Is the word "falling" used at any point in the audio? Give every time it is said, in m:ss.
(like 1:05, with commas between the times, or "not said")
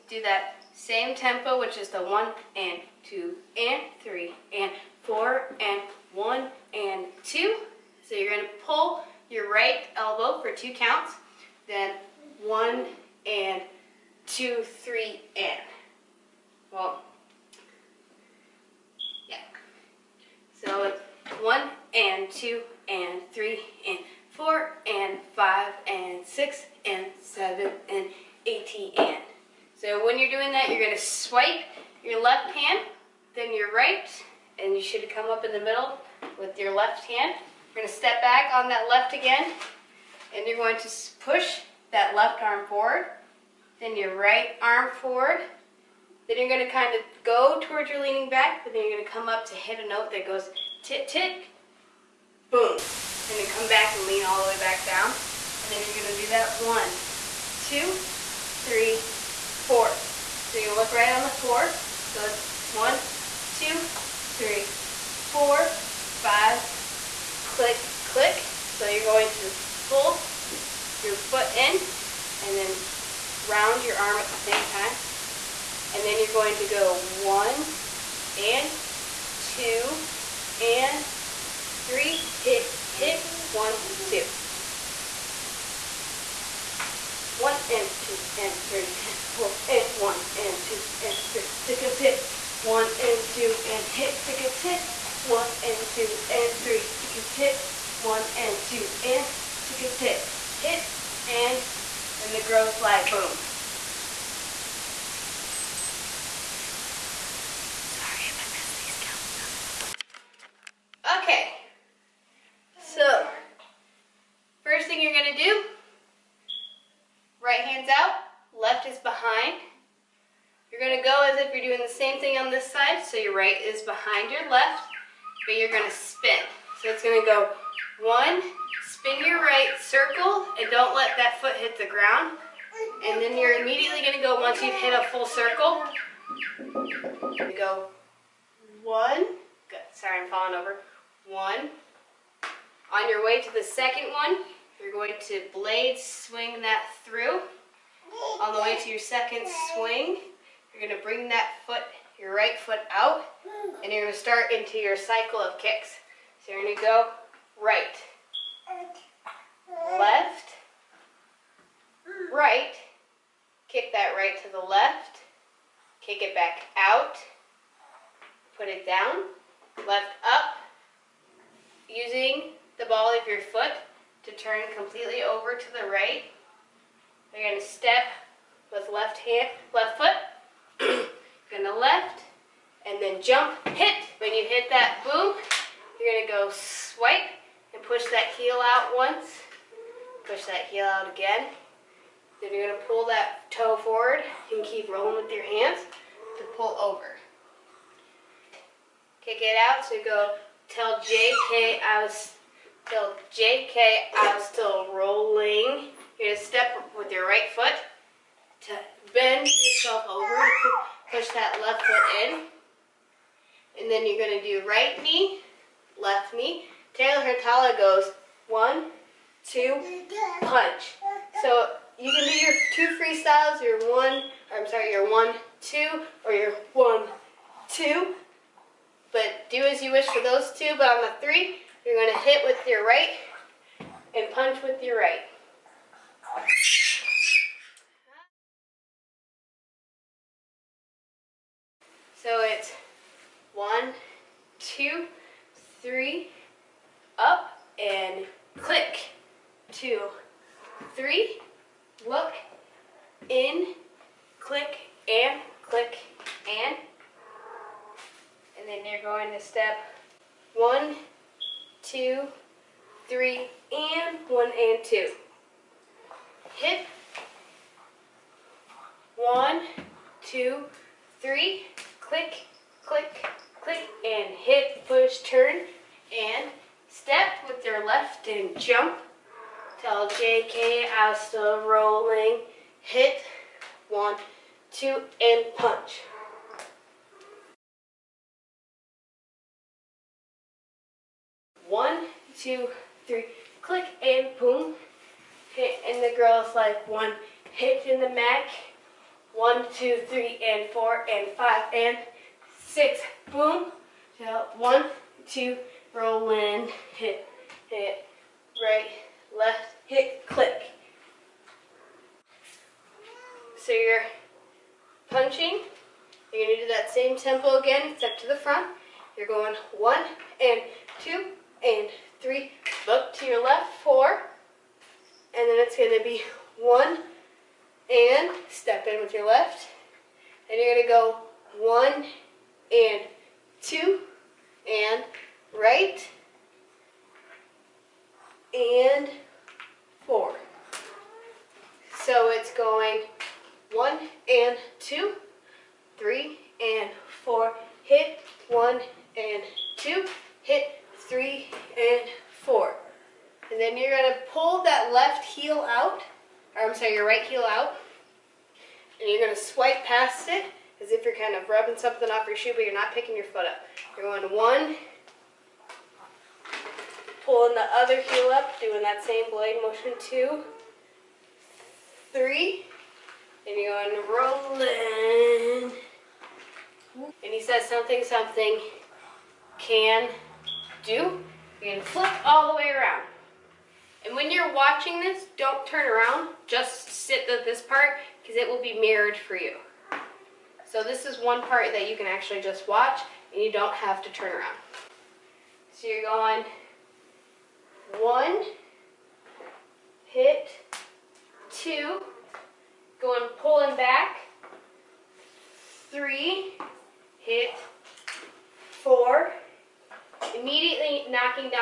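2:20.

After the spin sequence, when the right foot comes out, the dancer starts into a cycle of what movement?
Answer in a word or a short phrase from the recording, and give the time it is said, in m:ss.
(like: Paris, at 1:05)
kicks, at 2:35.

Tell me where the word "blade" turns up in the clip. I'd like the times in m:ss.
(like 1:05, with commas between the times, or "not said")
2:25, 6:09.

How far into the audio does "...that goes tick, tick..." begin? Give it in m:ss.
0:50.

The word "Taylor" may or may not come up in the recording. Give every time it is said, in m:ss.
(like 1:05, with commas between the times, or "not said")
3:36.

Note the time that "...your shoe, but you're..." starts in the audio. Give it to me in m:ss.
6:02.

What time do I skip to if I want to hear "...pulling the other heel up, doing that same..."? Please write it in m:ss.
6:07.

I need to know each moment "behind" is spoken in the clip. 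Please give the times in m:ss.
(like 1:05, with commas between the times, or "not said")
1:58, 2:03.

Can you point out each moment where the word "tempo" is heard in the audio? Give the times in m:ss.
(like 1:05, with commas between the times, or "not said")
0:01, 5:17.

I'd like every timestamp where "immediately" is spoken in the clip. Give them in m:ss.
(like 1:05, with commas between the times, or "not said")
2:13, 6:50.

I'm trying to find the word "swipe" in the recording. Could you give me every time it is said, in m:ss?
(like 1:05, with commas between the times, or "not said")
0:30, 5:59.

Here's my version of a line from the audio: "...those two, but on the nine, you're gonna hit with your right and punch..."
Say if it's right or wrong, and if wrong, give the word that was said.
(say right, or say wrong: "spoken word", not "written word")
wrong: "three", not "nine".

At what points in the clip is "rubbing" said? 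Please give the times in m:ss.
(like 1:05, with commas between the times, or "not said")
6:01.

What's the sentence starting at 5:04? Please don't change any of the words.
One, two, roll in, hit, hit, right, left, hit, click.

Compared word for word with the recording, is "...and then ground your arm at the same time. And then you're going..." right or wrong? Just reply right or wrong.
wrong.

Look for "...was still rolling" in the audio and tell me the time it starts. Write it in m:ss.
3:24.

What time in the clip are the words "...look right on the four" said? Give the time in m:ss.
1:00.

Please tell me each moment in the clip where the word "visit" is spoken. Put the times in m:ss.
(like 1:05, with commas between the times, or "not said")
not said.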